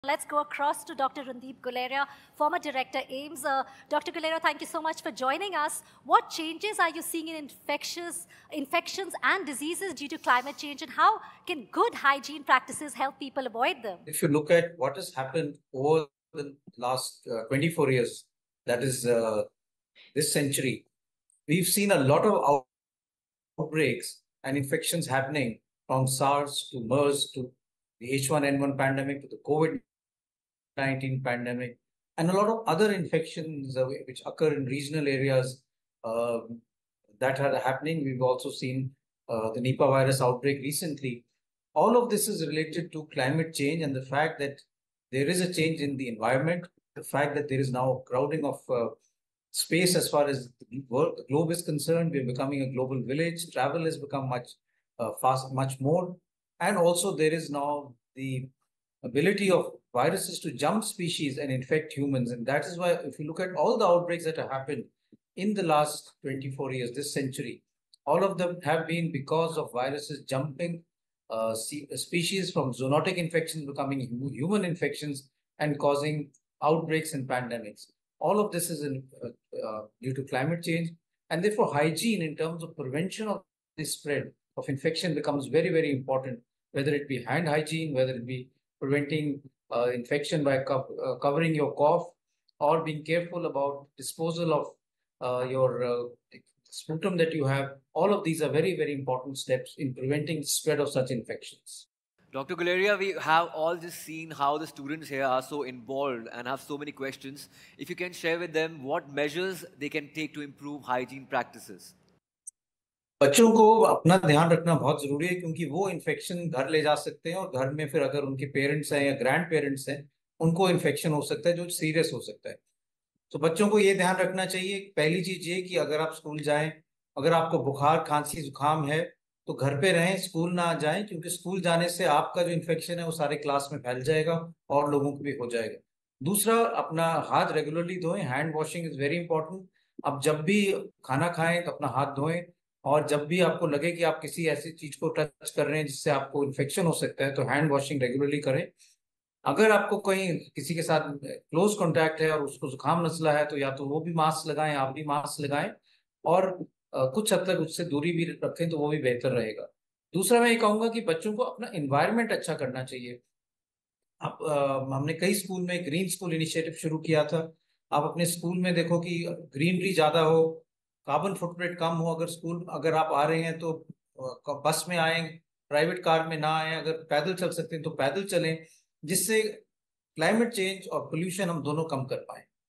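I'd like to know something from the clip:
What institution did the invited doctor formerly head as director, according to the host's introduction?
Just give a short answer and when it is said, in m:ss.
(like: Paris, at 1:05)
AIIMS, at 0:03.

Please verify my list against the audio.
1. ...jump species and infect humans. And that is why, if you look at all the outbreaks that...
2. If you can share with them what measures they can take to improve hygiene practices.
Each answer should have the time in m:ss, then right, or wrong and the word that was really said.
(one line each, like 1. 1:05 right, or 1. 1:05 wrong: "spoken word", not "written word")
1. 1:00 right
2. 1:47 right.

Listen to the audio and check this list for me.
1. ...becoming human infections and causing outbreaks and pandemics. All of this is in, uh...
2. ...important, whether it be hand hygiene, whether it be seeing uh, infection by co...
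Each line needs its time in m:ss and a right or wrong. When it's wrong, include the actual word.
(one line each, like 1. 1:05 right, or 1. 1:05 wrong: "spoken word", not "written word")
1. 1:13 right
2. 1:25 wrong: "preventing", not "seeing".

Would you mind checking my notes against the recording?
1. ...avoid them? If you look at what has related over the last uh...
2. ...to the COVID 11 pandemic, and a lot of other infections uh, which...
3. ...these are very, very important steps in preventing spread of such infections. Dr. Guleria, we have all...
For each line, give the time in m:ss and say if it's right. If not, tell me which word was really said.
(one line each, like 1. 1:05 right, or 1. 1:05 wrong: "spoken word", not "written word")
1. 0:13 wrong: "happened", not "related"
2. 0:29 wrong: "19", not "11"
3. 1:38 right.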